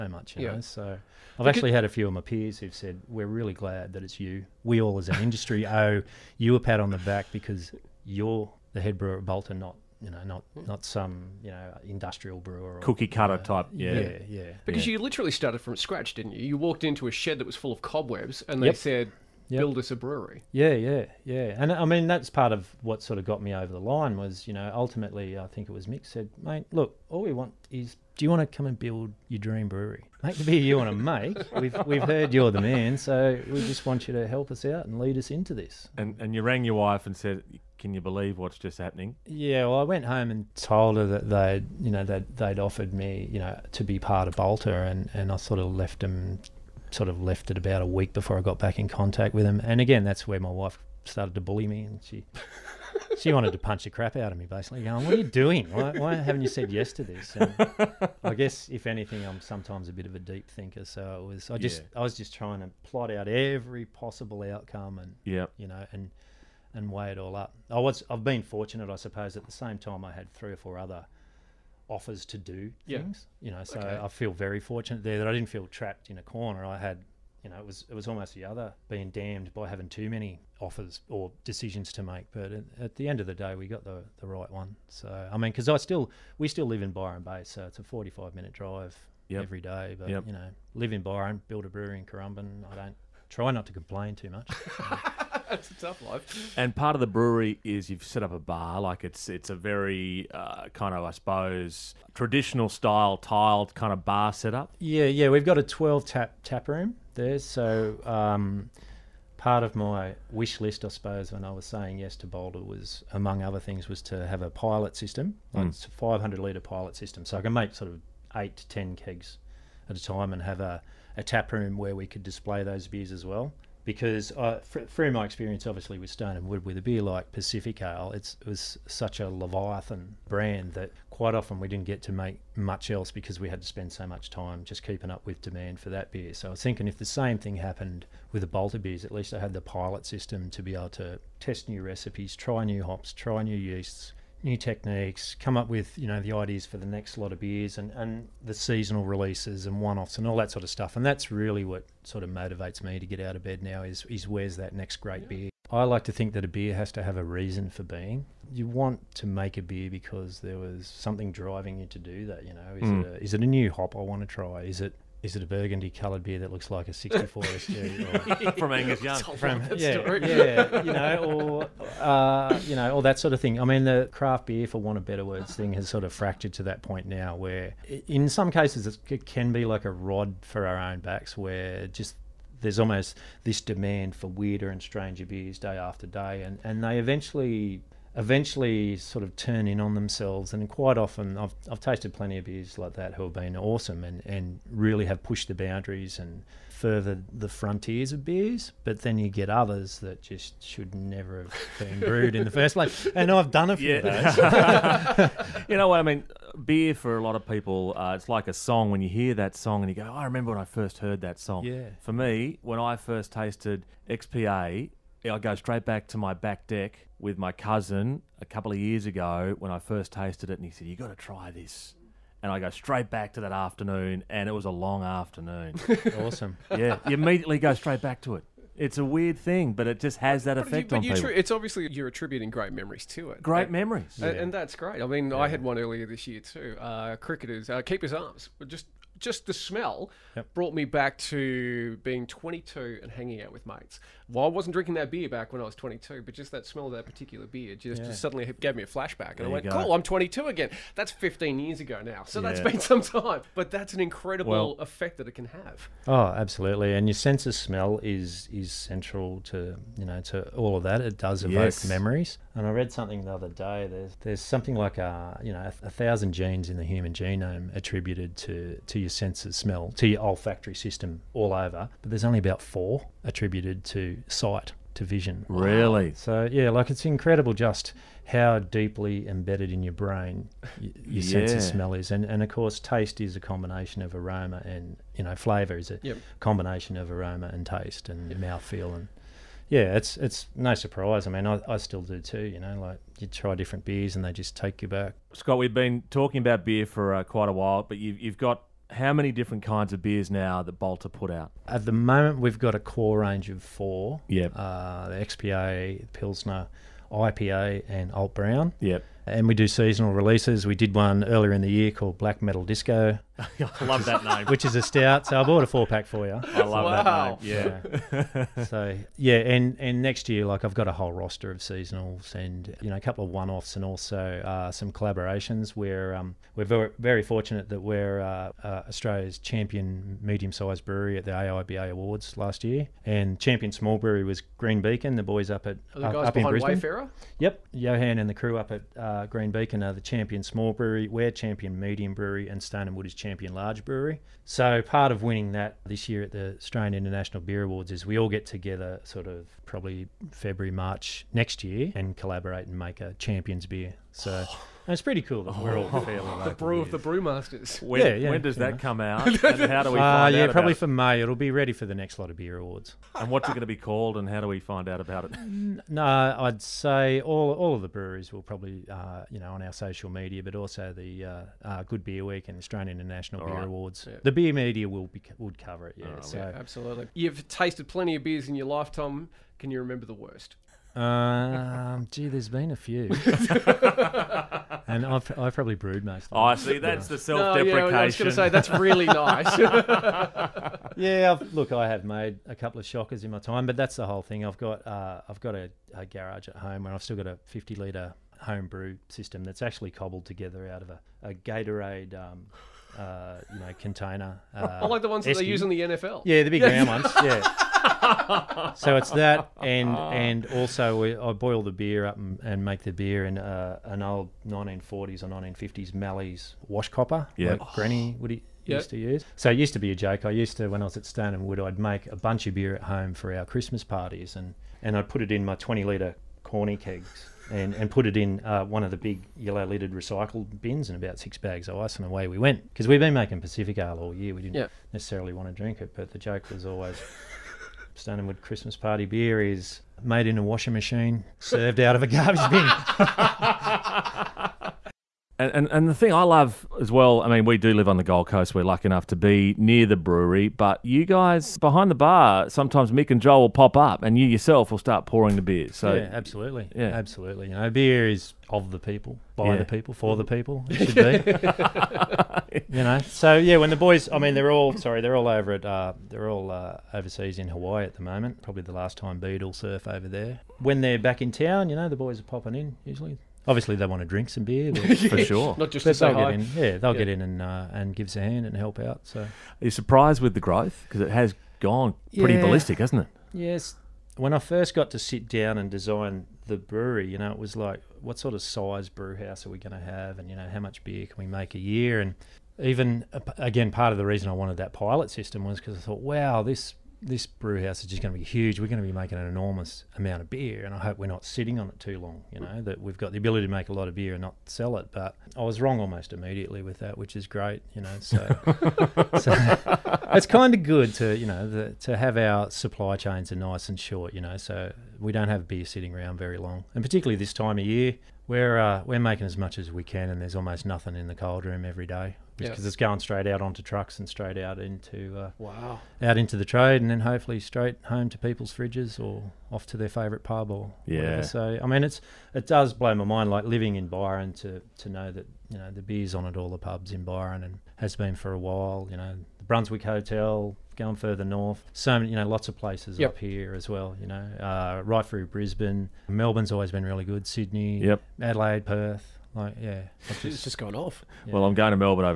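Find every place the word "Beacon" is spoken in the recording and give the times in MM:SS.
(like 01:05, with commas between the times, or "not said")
05:34, 05:39.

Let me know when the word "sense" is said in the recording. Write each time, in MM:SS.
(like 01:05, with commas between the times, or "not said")
04:17, 04:41.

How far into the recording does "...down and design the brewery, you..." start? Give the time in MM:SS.
08:05.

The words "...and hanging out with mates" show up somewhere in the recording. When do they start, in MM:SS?
04:03.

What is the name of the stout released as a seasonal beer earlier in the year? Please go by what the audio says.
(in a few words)
Black Metal Disco.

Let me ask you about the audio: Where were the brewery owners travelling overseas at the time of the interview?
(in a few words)
Hawaii.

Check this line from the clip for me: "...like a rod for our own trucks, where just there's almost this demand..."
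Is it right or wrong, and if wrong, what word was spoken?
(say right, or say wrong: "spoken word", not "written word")
wrong: "backs", not "trucks".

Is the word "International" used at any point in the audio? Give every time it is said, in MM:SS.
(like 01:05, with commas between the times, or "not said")
05:46, 06:12.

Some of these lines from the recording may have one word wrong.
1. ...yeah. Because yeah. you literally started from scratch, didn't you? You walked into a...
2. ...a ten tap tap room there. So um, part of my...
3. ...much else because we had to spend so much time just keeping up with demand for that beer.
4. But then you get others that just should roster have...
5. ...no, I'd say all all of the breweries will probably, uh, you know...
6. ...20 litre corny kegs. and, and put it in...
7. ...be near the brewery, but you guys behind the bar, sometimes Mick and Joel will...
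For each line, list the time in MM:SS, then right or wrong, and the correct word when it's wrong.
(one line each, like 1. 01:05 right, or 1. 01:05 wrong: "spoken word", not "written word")
1. 00:14 right
2. 01:45 wrong: "twelve", not "ten"
3. 02:12 right
4. 03:18 wrong: "never", not "roster"
5. 06:05 right
6. 07:05 right
7. 07:29 right.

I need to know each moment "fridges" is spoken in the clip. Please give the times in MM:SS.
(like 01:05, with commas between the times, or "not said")
08:48.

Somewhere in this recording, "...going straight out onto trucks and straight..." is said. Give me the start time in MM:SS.
08:42.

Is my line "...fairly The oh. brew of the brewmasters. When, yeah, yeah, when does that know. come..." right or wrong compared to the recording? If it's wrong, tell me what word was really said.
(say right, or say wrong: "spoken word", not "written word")
right.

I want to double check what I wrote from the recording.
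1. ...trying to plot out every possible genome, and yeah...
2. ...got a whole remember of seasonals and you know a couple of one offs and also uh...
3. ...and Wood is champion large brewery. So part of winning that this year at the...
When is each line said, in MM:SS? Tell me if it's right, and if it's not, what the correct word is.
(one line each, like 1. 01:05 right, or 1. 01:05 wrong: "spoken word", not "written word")
1. 01:02 wrong: "outcome", not "genome"
2. 05:20 wrong: "roster", not "remember"
3. 05:42 right.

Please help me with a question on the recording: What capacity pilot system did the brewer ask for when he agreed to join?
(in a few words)
500 litres.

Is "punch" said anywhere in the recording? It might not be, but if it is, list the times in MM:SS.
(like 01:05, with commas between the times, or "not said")
00:53.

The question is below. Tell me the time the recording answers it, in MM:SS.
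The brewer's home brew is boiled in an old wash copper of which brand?
06:55.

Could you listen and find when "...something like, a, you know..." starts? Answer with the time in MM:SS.
04:24.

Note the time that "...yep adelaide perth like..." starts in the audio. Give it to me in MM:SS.
09:07.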